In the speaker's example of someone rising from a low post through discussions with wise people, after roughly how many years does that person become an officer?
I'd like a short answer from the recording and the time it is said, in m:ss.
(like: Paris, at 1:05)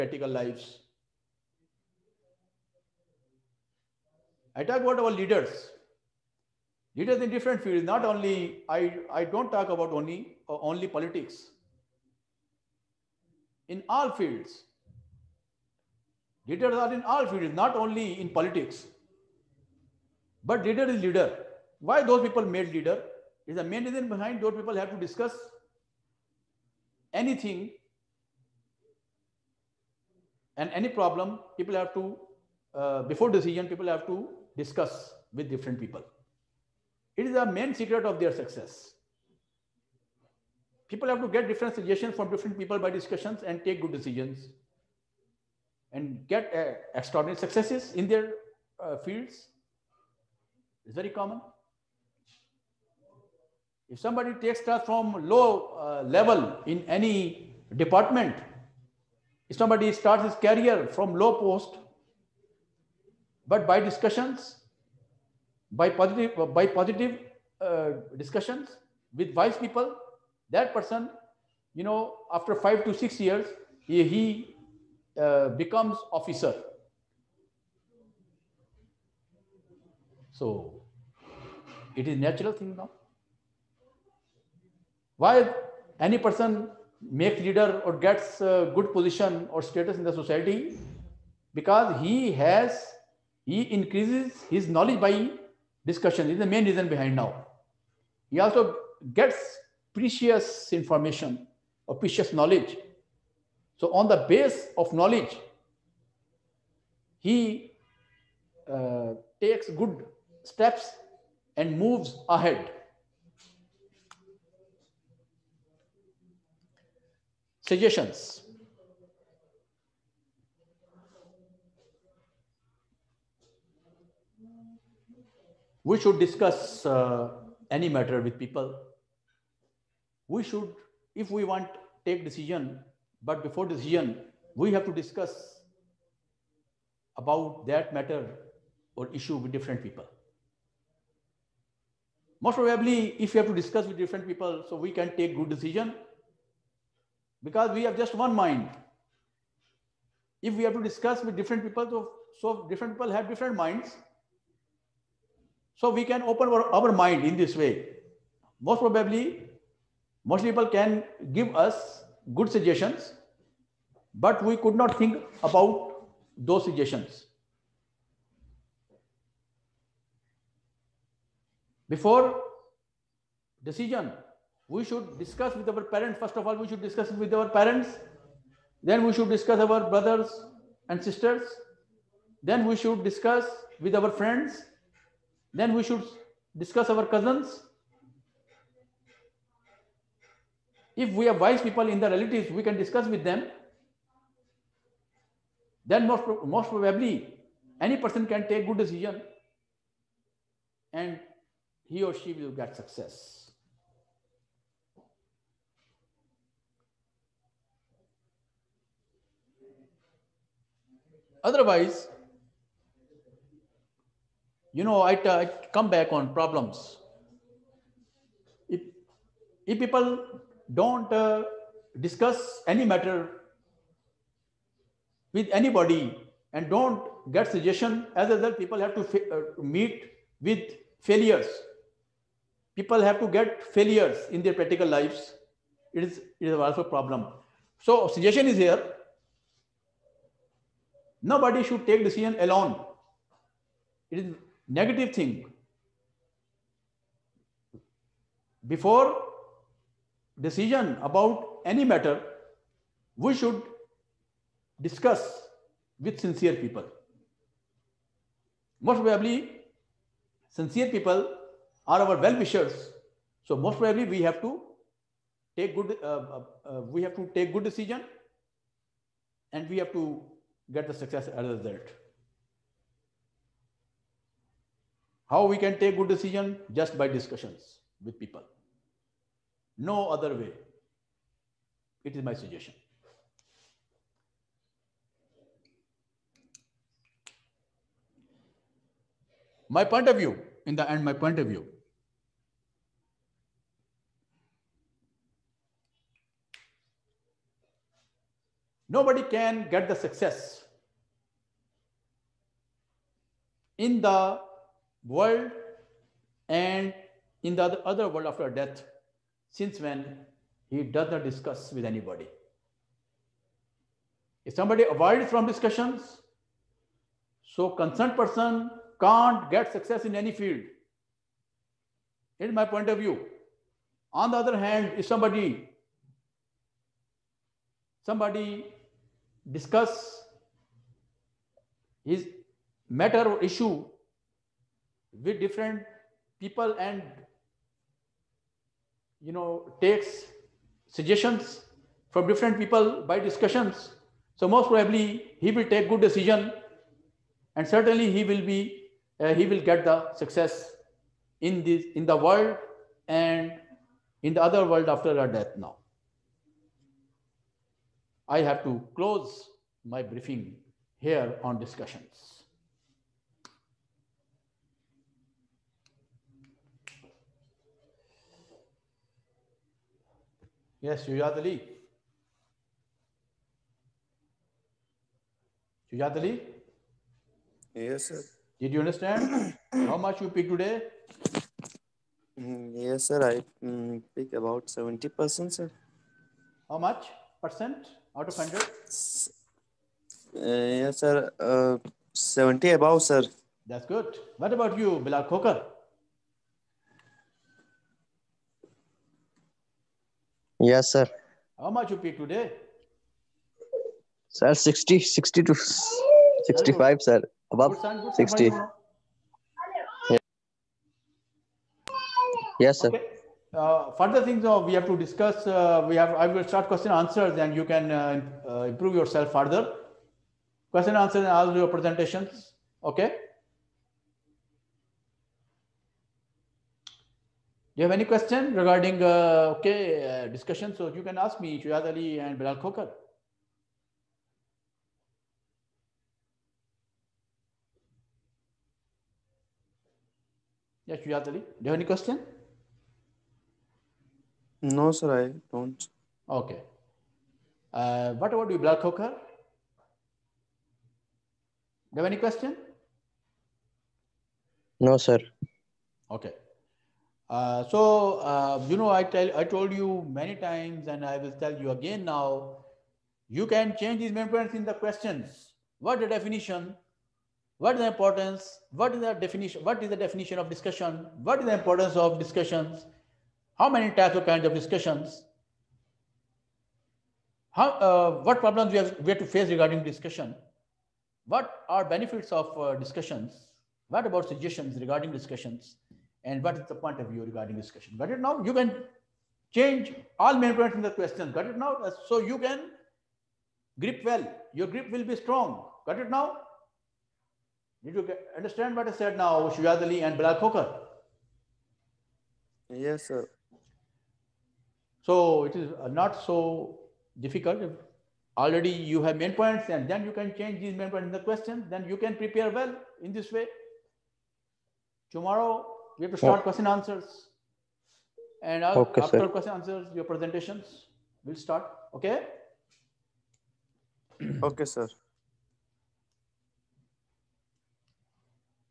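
5 to 6, at 1:12.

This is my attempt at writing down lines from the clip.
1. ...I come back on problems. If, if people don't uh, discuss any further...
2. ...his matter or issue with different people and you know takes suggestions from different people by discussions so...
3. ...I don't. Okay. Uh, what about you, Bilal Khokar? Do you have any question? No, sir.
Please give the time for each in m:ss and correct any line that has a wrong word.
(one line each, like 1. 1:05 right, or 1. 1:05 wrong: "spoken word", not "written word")
1. 3:35 wrong: "matter", not "further"
2. 5:32 right
3. 7:25 right.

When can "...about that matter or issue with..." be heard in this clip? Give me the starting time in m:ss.
2:17.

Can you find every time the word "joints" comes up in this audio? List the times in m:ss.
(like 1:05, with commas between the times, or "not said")
not said.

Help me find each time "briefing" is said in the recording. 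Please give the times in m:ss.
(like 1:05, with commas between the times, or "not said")
6:00.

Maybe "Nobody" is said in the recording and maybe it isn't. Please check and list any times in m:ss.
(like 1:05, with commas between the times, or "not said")
4:01, 4:58.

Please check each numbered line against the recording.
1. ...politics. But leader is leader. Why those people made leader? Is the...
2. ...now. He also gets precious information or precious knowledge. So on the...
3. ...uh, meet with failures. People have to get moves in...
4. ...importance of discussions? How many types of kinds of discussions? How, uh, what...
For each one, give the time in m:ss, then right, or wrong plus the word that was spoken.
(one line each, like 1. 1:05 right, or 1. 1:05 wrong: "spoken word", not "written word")
1. 0:18 right
2. 1:37 right
3. 3:49 wrong: "failures", not "moves"
4. 7:51 right.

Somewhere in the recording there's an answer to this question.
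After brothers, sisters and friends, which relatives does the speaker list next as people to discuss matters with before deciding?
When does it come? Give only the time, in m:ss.
3:07.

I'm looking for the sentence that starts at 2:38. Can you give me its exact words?
Most probably, most people can give us good suggestions, but we could not think about those suggestions.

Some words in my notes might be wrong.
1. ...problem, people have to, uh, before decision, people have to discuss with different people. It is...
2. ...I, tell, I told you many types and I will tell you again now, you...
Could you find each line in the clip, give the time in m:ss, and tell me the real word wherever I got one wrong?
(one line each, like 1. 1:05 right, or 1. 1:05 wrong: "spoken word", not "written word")
1. 0:30 right
2. 7:38 wrong: "times", not "types".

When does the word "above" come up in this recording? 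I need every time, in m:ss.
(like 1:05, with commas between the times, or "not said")
6:32, 6:47.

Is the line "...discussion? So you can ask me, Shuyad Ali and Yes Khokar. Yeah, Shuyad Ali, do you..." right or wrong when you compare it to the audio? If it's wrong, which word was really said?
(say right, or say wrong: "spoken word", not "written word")
wrong: "Bilal", not "Yes".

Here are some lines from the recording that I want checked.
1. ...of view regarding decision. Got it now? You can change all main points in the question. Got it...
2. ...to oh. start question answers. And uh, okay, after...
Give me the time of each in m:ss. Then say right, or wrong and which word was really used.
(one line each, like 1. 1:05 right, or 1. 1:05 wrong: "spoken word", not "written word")
1. 8:06 wrong: "discussion", not "decision"
2. 8:36 right.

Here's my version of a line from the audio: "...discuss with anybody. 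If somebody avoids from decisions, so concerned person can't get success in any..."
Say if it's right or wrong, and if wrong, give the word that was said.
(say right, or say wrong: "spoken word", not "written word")
wrong: "discussions", not "decisions".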